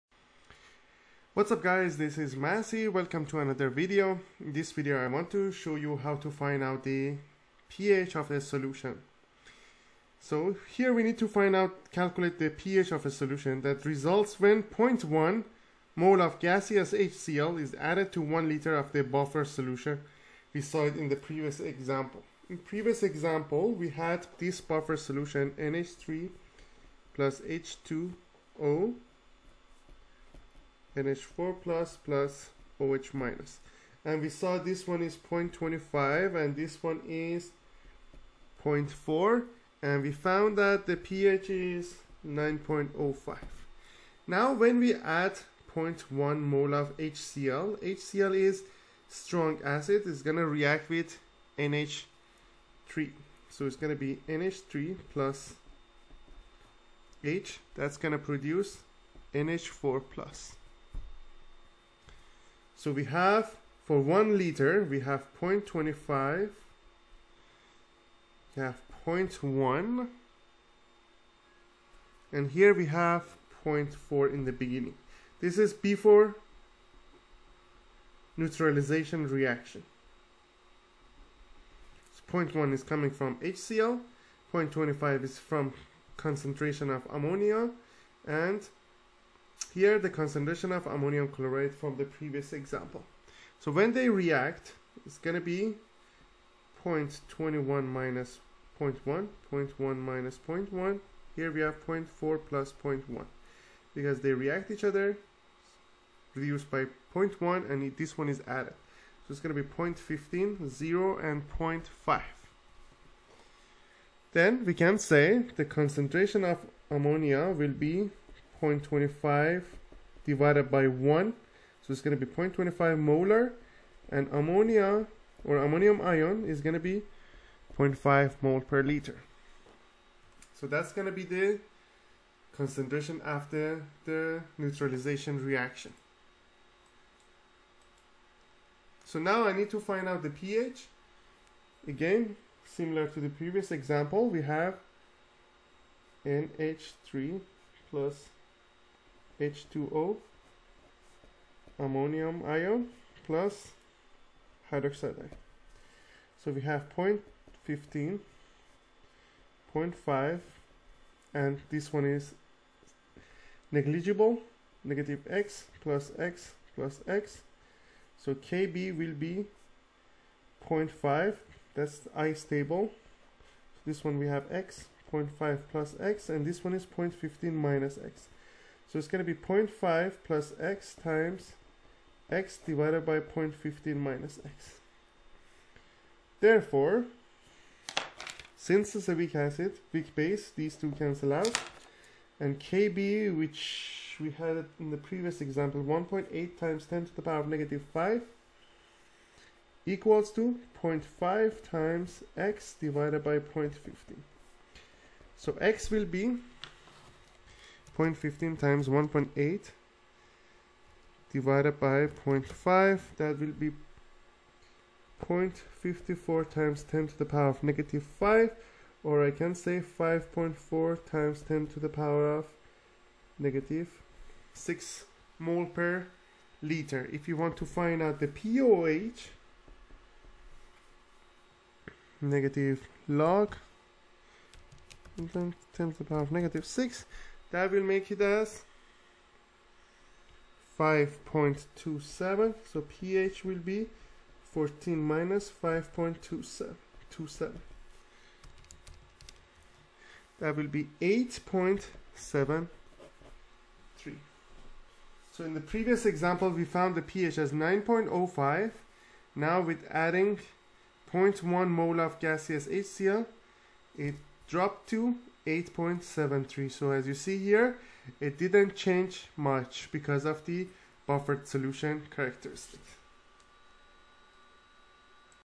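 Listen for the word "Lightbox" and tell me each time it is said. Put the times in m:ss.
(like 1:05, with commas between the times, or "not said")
not said.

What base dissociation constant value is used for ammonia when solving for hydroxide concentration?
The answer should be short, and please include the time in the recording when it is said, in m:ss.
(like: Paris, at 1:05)
1.8 times 10^-5, at 3:15.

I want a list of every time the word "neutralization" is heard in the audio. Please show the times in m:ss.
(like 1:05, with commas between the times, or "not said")
1:18, 2:14.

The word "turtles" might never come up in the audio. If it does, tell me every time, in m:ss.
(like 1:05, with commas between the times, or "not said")
not said.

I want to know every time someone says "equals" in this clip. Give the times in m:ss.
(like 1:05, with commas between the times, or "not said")
3:19.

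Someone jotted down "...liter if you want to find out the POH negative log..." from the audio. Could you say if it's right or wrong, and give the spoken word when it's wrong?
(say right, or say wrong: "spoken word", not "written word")
right.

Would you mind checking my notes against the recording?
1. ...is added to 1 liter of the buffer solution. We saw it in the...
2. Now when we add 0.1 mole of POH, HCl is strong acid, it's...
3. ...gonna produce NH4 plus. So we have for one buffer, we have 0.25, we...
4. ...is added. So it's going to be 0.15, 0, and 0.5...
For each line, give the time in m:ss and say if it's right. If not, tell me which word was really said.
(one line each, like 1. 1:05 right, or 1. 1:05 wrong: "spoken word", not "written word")
1. 0:17 right
2. 0:44 wrong: "HCl", not "POH"
3. 0:57 wrong: "liter", not "buffer"
4. 1:48 right.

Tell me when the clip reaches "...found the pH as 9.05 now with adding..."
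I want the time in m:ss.
4:16.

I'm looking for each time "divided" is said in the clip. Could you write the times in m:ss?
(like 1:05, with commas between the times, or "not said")
2:00, 3:02, 3:22, 3:31.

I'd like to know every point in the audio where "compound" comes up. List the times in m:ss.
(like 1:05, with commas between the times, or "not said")
not said.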